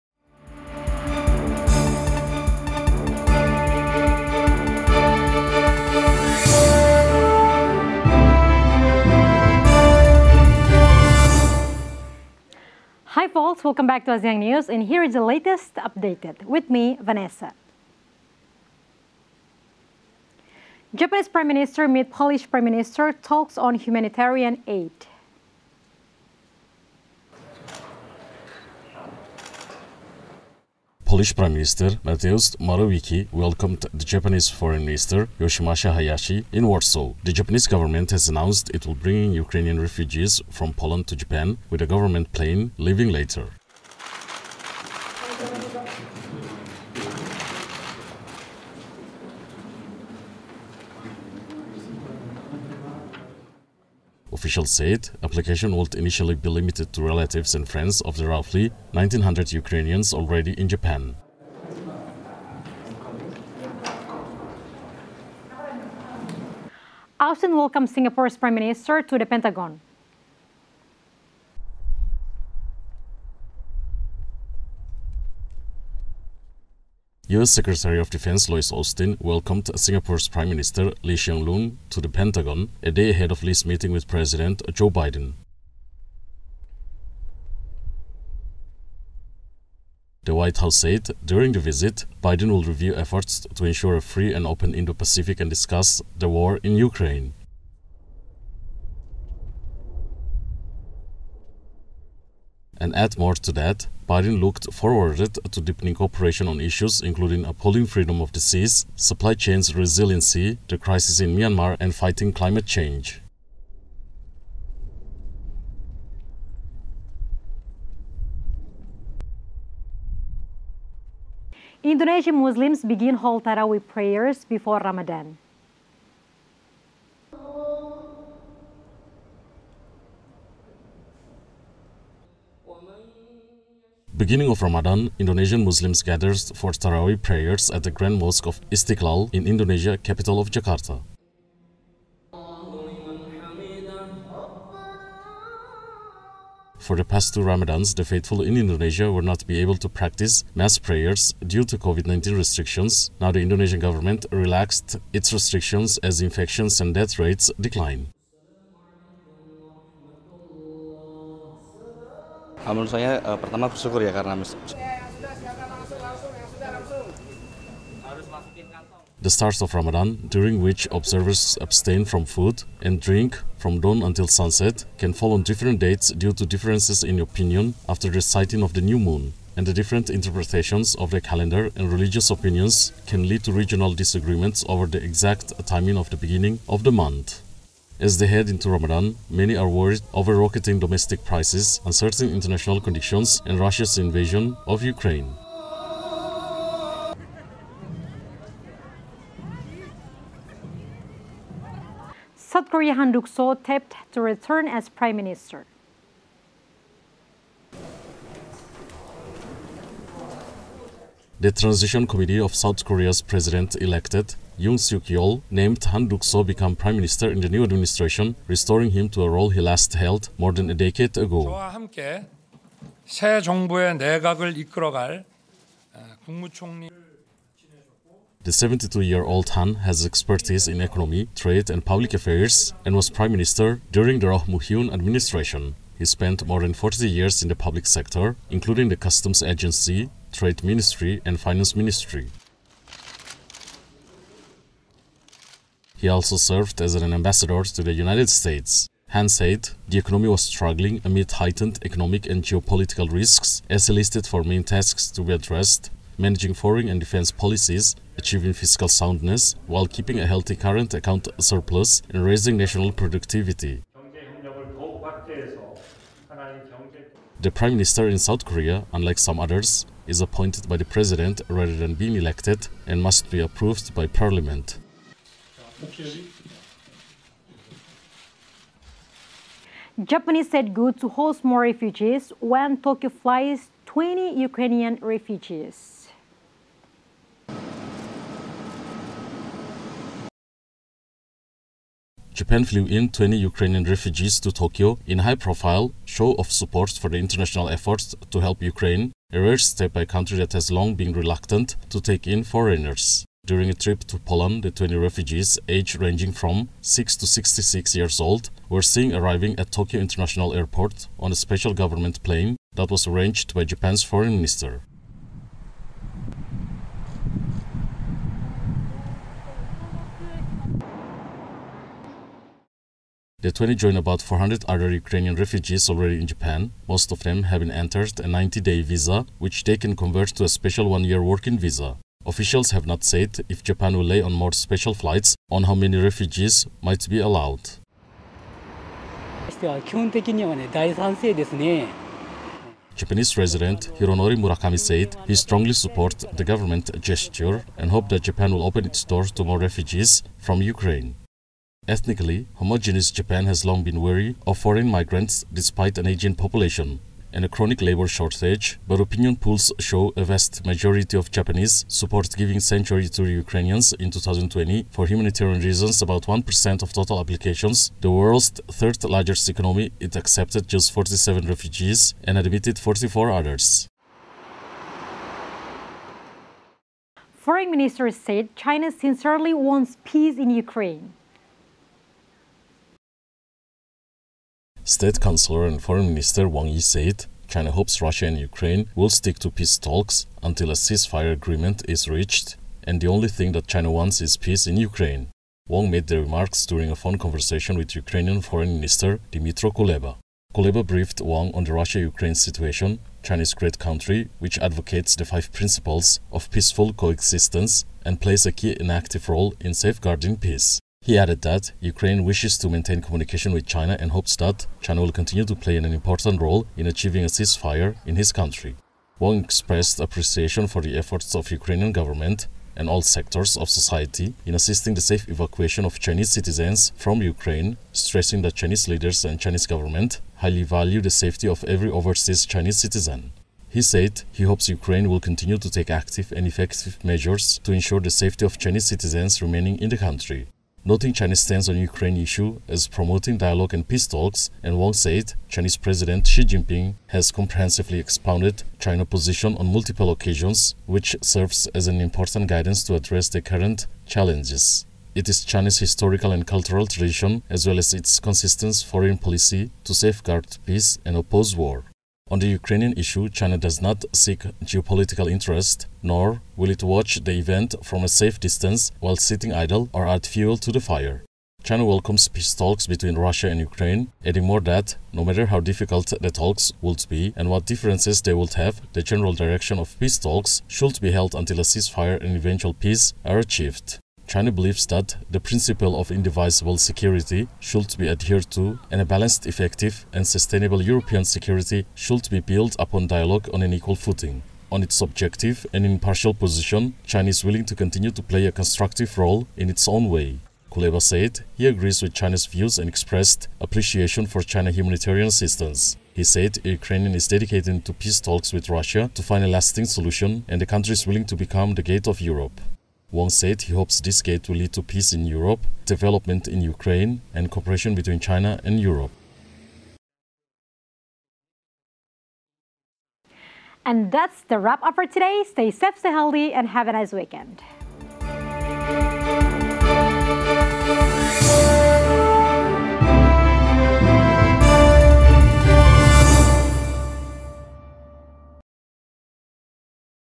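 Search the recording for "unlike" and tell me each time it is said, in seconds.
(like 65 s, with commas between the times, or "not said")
268 s.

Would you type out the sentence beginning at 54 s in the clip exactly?
Officials said application would initially be limited to relatives and friends of the roughly 1,900 Ukrainians already in Japan.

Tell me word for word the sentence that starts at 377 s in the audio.
Foreign Minister said China sincerely wants peace in Ukraine.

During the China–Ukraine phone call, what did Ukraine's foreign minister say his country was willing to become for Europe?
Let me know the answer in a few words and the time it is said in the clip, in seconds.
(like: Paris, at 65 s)
the gate of Europe, at 511 s.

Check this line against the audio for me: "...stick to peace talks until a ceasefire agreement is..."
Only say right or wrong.
right.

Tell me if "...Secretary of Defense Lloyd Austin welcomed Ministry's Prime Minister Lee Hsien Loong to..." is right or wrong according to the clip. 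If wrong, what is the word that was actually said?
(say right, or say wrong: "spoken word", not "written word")
wrong: "Singapore", not "Ministry".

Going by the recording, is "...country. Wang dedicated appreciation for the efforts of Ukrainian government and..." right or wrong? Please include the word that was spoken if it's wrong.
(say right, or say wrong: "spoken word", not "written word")
wrong: "expressed", not "dedicated".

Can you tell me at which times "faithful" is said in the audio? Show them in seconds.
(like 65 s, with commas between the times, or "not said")
148 s.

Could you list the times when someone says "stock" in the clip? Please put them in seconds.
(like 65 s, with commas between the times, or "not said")
not said.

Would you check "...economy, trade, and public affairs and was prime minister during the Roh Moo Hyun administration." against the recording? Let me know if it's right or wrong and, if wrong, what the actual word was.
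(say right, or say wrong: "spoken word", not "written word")
right.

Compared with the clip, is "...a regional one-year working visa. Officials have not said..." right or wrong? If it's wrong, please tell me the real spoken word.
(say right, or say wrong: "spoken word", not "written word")
wrong: "special", not "regional".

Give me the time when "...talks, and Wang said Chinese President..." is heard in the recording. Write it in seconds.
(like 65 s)
444 s.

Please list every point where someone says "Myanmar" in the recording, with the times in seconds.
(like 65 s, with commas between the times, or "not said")
111 s.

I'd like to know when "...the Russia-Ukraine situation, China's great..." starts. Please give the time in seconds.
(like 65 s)
401 s.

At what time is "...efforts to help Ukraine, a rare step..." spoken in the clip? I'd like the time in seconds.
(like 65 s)
297 s.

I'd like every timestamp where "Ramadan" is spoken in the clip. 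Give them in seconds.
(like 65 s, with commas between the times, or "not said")
124 s, 134 s, 147 s, 169 s, 188 s.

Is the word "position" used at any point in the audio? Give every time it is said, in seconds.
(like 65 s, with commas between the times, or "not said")
449 s, 496 s.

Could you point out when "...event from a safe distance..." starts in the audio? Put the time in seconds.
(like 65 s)
467 s.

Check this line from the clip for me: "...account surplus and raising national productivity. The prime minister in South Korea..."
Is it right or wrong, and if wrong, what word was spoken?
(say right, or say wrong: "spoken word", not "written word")
right.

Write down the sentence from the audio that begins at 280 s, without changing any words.
Japanese said good to host more refugees when Tokyo flies 20 Ukrainian refugees.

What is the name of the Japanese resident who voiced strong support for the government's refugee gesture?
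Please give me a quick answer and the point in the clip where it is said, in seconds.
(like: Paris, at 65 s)
Hironori Murakami, at 343 s.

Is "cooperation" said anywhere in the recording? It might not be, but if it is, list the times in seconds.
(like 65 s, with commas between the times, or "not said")
105 s, 517 s.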